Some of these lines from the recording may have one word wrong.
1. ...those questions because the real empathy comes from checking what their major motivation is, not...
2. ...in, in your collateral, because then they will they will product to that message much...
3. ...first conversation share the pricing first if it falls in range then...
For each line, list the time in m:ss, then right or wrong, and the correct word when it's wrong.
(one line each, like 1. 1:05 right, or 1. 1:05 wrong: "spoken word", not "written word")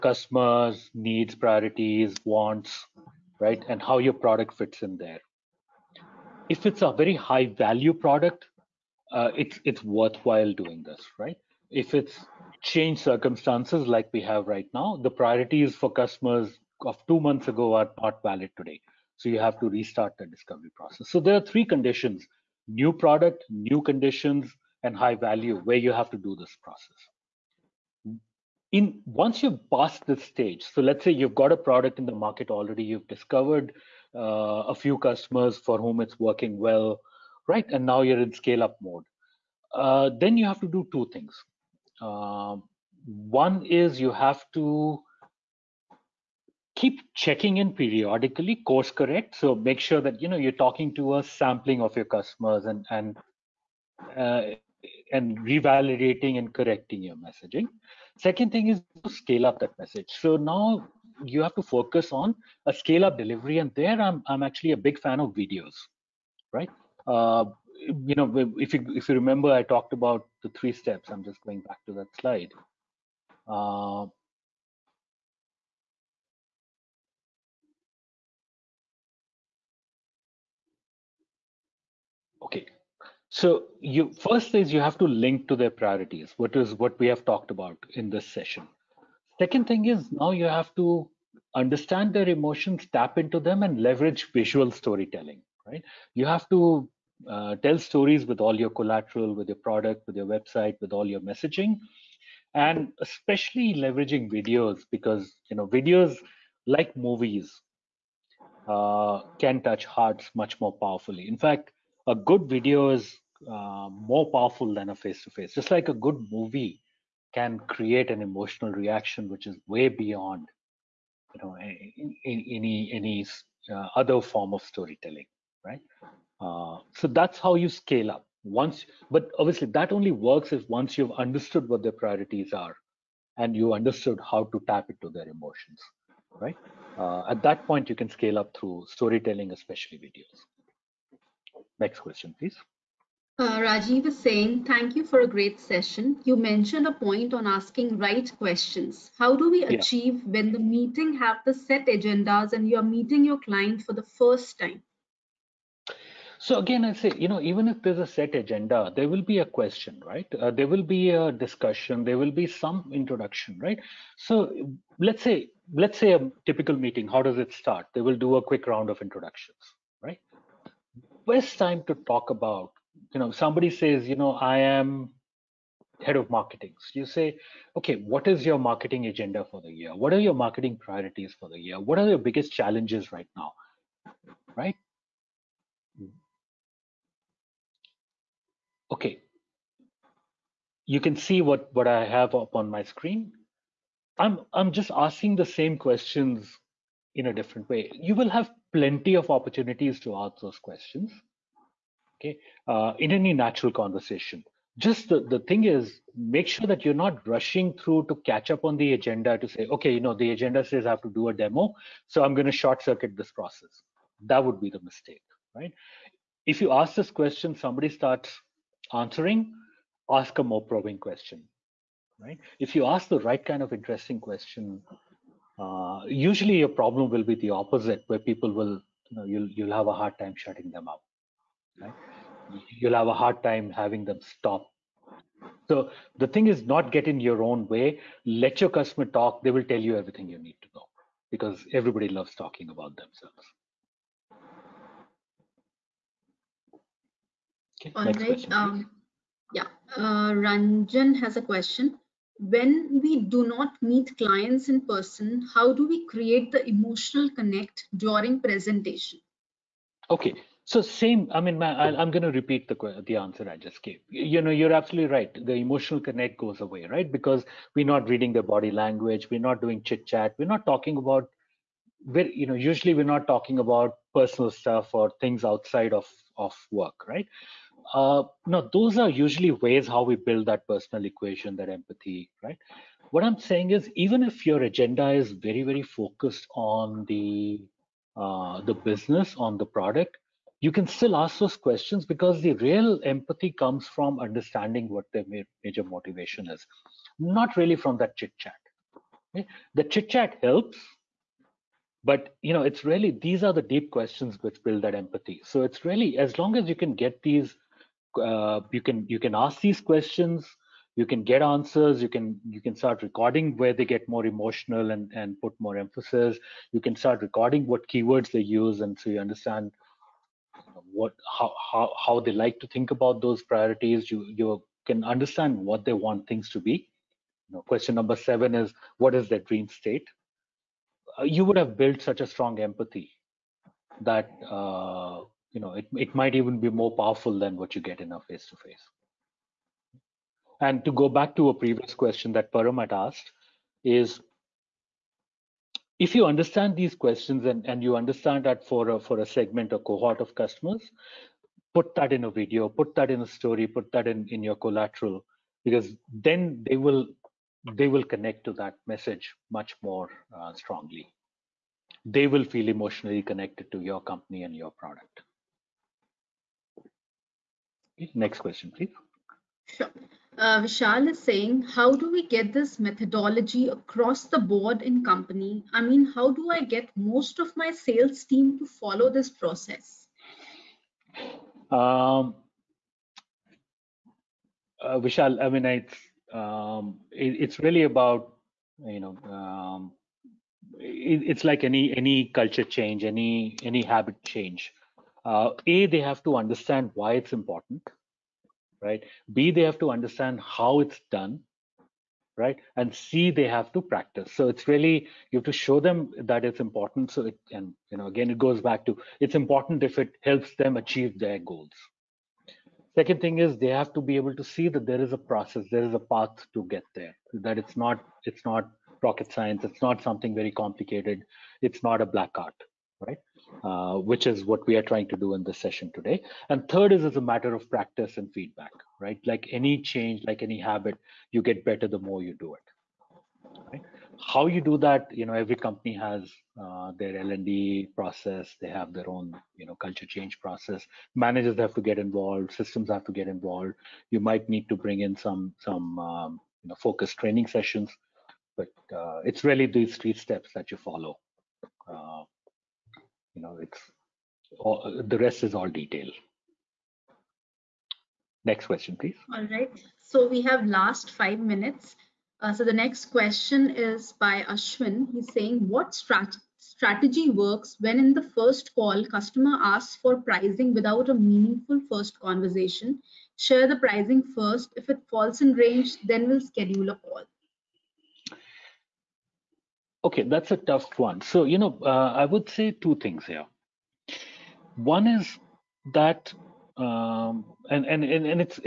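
1. 4:51 wrong: "understanding", not "checking"
2. 5:54 wrong: "connect", not "product"
3. 7:51 right.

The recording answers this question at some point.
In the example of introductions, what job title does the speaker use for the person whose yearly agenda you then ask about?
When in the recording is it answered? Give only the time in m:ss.
2:56.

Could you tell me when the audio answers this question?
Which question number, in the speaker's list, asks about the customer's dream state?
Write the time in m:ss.
5:28.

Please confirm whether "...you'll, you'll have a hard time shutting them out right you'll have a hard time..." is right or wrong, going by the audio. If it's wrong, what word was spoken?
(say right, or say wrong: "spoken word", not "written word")
right.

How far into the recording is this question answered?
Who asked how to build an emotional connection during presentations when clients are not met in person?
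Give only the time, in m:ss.
4:10.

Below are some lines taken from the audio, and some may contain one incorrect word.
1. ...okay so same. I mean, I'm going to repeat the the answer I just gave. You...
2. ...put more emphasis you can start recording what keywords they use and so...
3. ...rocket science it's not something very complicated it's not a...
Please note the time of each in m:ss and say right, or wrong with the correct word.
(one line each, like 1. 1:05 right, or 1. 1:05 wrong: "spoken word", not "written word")
1. 4:20 right
2. 5:15 right
3. 6:59 right.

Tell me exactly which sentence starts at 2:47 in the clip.
They will do a quick round of introductions, right?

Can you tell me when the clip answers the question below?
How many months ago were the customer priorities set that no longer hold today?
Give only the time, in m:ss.
0:17.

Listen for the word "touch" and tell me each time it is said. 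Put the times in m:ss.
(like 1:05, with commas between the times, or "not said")
1:49.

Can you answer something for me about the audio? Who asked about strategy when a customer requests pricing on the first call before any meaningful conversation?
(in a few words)
Ashwin.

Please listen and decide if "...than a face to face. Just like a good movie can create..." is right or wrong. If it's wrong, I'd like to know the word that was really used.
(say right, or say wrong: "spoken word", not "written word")
right.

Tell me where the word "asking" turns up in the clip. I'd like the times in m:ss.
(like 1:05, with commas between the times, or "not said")
2:27, 3:14.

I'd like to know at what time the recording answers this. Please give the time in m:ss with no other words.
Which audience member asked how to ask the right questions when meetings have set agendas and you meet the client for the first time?
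2:23.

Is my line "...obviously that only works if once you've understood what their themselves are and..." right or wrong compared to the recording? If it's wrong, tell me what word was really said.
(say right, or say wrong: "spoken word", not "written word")
wrong: "priorities", not "themselves".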